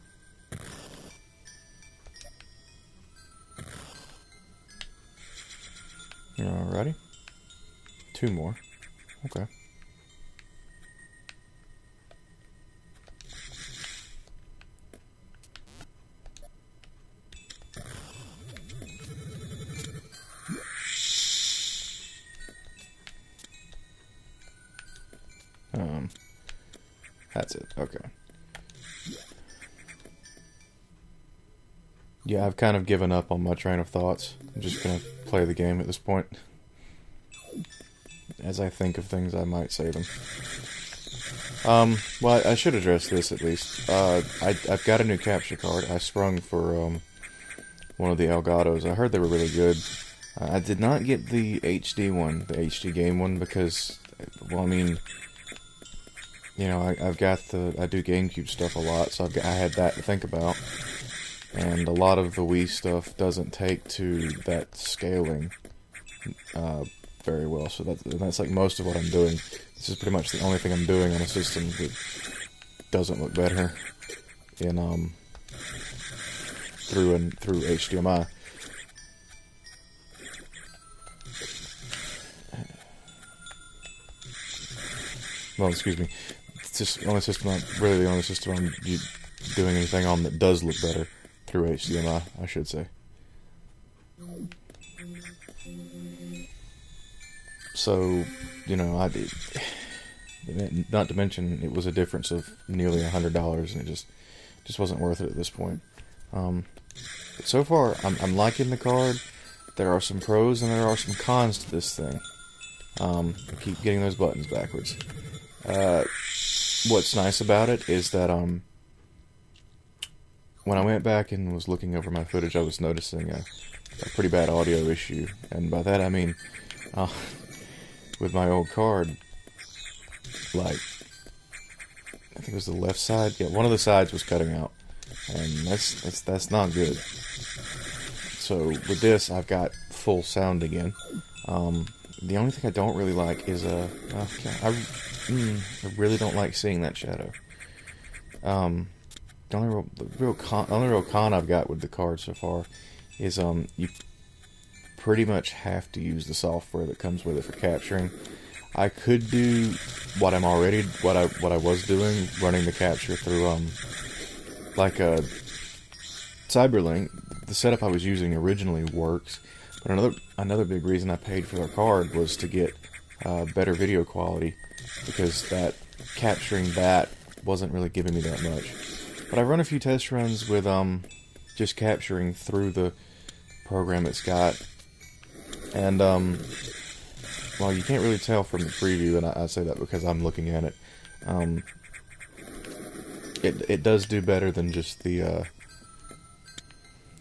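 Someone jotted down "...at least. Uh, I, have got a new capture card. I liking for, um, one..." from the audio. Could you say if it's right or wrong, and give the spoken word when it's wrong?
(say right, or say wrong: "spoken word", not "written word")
wrong: "sprung", not "liking".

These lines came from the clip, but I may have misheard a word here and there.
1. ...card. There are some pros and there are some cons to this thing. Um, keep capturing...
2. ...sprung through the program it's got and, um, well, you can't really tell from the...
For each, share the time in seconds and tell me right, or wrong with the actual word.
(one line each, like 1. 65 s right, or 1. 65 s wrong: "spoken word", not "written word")
1. 108 s wrong: "getting", not "capturing"
2. 181 s wrong: "capturing", not "sprung".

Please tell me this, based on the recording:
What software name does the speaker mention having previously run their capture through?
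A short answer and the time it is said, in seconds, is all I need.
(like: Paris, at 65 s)
Cyberlink, at 166 s.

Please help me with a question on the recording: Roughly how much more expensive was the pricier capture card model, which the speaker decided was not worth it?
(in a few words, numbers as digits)
nearly $100.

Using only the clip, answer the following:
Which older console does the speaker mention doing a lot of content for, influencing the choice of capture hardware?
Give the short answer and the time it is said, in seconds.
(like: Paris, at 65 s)
GameCube, at 58 s.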